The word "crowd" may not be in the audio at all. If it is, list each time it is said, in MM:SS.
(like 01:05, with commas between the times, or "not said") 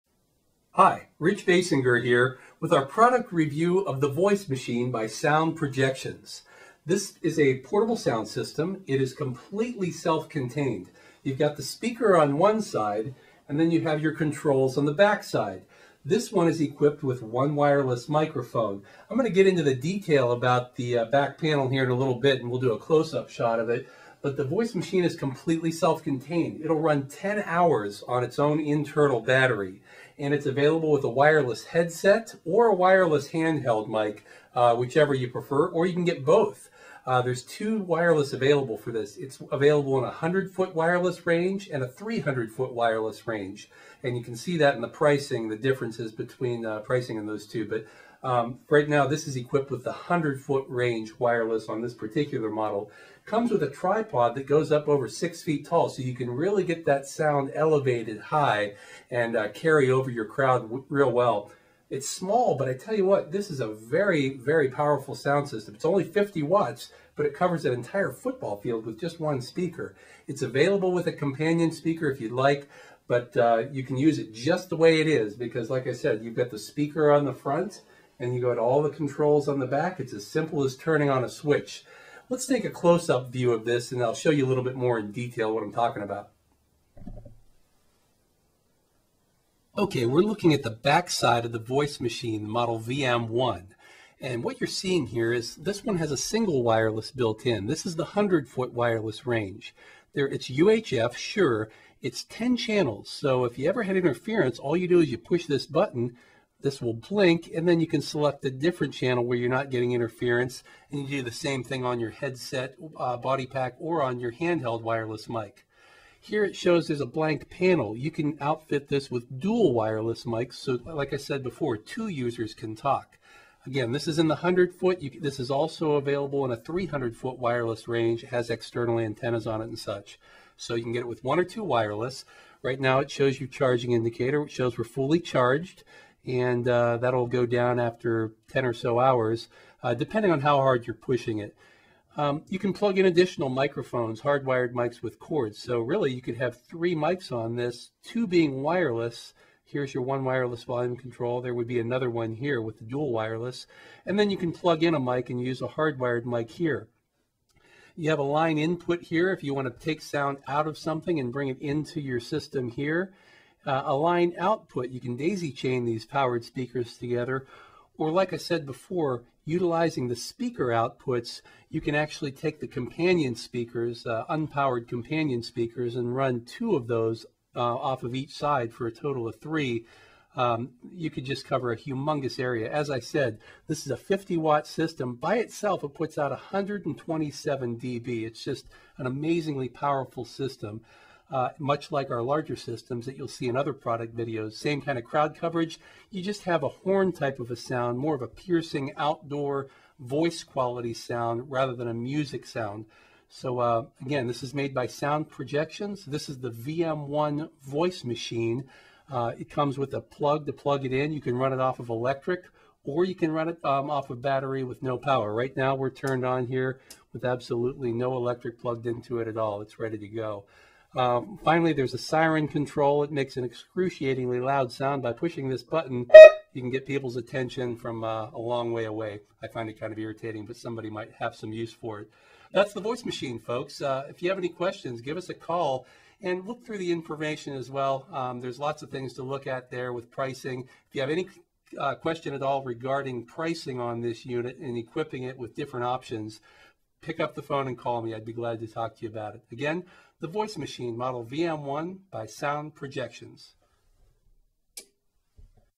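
01:00, 03:15.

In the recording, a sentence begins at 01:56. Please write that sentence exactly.
Here it shows there's a blank panel.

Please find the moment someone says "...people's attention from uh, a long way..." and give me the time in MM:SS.
03:46.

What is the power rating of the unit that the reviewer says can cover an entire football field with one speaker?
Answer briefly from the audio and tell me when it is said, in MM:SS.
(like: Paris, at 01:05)
50 watts, at 01:06.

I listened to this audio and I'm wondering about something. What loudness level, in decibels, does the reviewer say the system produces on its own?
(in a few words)
127 dB.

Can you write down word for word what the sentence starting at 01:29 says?
Okay, we're looking at the back side of the voice machine, the model VM1.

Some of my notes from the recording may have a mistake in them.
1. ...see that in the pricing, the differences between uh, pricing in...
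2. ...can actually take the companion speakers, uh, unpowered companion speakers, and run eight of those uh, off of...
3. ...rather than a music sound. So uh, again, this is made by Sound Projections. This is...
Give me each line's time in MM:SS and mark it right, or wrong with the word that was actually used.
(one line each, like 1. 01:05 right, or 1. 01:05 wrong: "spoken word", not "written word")
1. 00:44 right
2. 02:51 wrong: "two", not "eight"
3. 03:21 right.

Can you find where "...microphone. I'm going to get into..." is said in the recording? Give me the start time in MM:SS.
00:18.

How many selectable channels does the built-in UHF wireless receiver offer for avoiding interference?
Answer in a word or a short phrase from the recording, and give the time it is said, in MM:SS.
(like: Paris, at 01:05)
10, at 01:42.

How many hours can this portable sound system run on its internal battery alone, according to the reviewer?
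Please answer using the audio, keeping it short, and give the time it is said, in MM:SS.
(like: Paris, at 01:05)
10 hours, at 00:27.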